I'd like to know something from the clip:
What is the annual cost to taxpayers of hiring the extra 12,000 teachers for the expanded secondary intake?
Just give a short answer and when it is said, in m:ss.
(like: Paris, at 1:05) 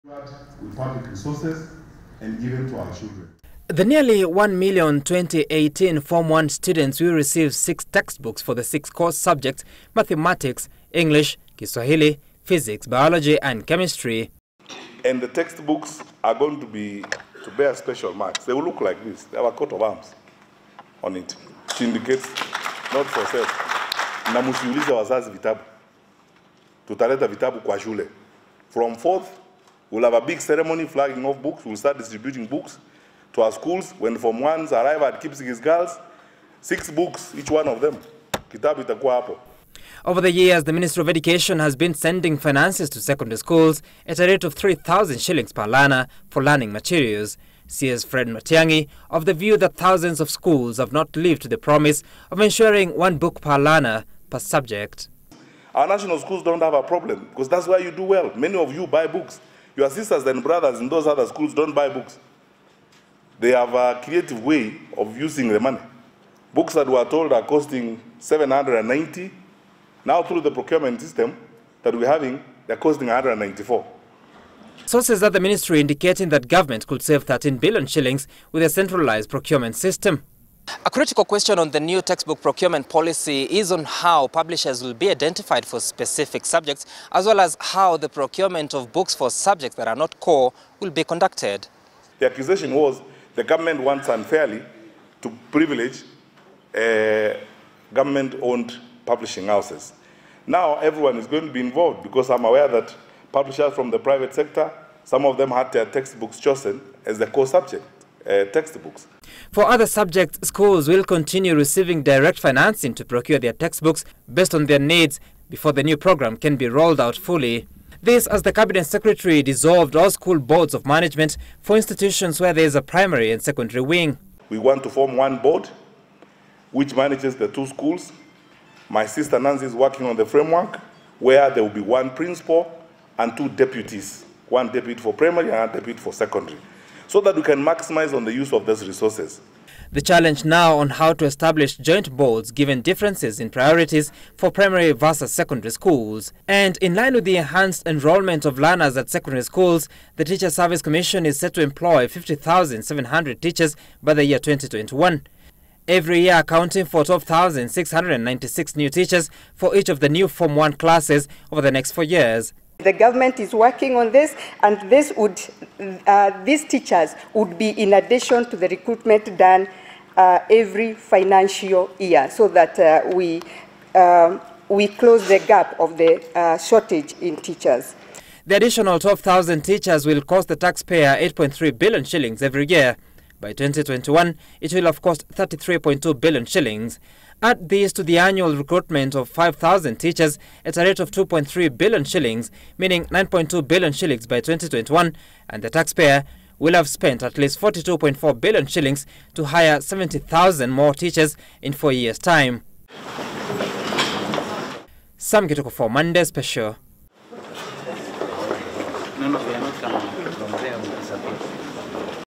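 8.3 billion shillings, at 3:01.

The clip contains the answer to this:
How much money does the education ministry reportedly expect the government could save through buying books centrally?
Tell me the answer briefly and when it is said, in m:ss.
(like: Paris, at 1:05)
13 billion shillings, at 1:17.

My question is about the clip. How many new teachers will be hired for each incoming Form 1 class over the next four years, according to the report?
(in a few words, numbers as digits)
12,696.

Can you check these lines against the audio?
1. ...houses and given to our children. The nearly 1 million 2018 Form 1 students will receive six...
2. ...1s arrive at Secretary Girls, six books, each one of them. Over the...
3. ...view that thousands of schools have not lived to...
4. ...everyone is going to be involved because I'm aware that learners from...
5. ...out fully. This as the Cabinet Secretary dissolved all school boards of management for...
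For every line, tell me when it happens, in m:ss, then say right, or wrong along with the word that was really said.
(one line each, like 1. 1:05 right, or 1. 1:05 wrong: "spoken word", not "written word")
1. 0:01 wrong: "resources", not "houses"
2. 0:34 wrong: "Kipsigis", not "Secretary"
3. 0:49 right
4. 1:40 wrong: "publishers", not "learners"
5. 1:56 right.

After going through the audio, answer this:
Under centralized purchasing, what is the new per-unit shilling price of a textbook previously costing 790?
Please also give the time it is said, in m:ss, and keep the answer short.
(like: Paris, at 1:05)
194, at 1:13.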